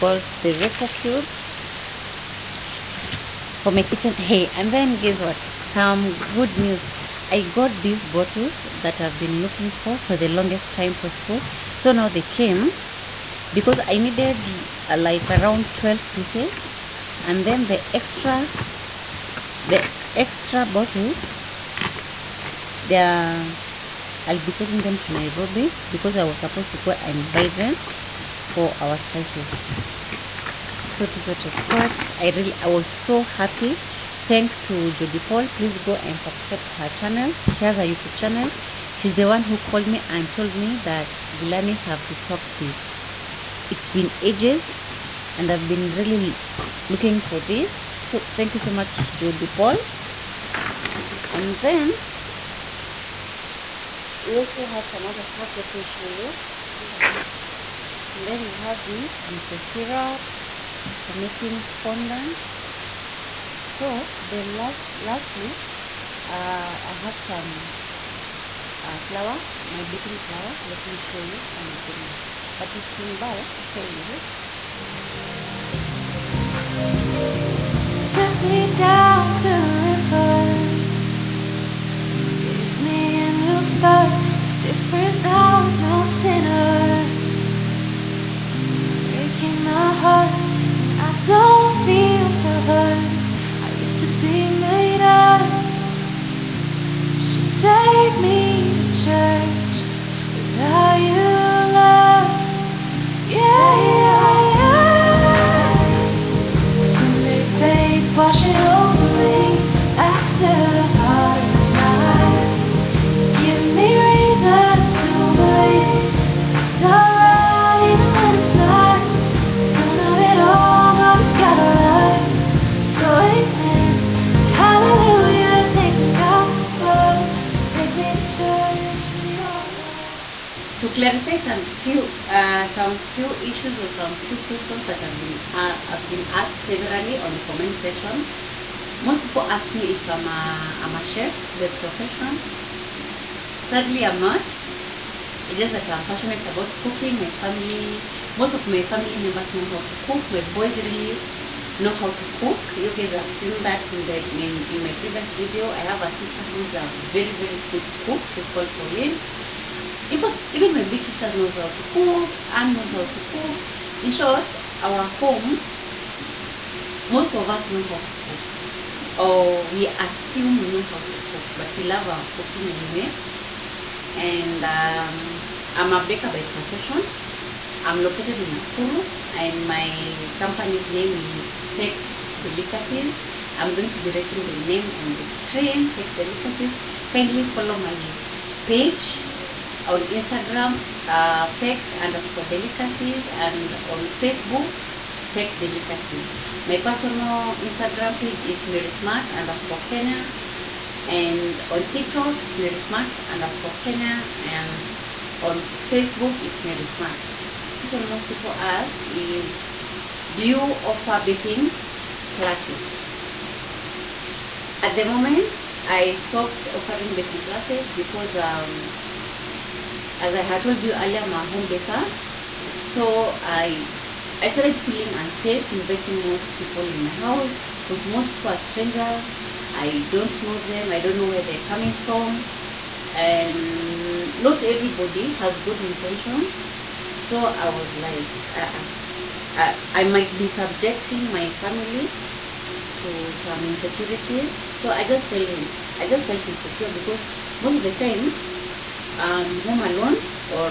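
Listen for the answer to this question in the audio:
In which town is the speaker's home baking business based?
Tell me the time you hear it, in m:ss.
2:58.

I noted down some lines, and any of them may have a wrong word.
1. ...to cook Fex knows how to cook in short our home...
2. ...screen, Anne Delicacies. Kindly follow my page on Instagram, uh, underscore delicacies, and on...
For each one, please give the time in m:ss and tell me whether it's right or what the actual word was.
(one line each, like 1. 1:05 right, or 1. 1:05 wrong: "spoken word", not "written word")
1. 2:41 wrong: "Anne", not "Fex"
2. 3:05 wrong: "Fex", not "Anne".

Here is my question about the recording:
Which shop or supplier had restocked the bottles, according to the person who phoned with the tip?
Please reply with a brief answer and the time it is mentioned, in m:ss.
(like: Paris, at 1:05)
Gilanis, at 0:41.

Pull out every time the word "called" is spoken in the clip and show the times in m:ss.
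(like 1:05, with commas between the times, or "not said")
0:39, 2:38.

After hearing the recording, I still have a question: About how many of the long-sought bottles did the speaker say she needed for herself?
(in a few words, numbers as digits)
12.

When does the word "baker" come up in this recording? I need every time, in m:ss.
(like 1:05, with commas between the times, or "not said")
2:56, 3:41.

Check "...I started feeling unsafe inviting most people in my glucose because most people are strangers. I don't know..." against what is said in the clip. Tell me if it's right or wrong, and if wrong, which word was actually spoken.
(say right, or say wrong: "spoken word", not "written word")
wrong: "house", not "glucose".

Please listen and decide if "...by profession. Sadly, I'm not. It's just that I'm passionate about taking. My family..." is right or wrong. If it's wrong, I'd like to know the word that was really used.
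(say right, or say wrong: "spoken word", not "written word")
wrong: "cooking", not "taking".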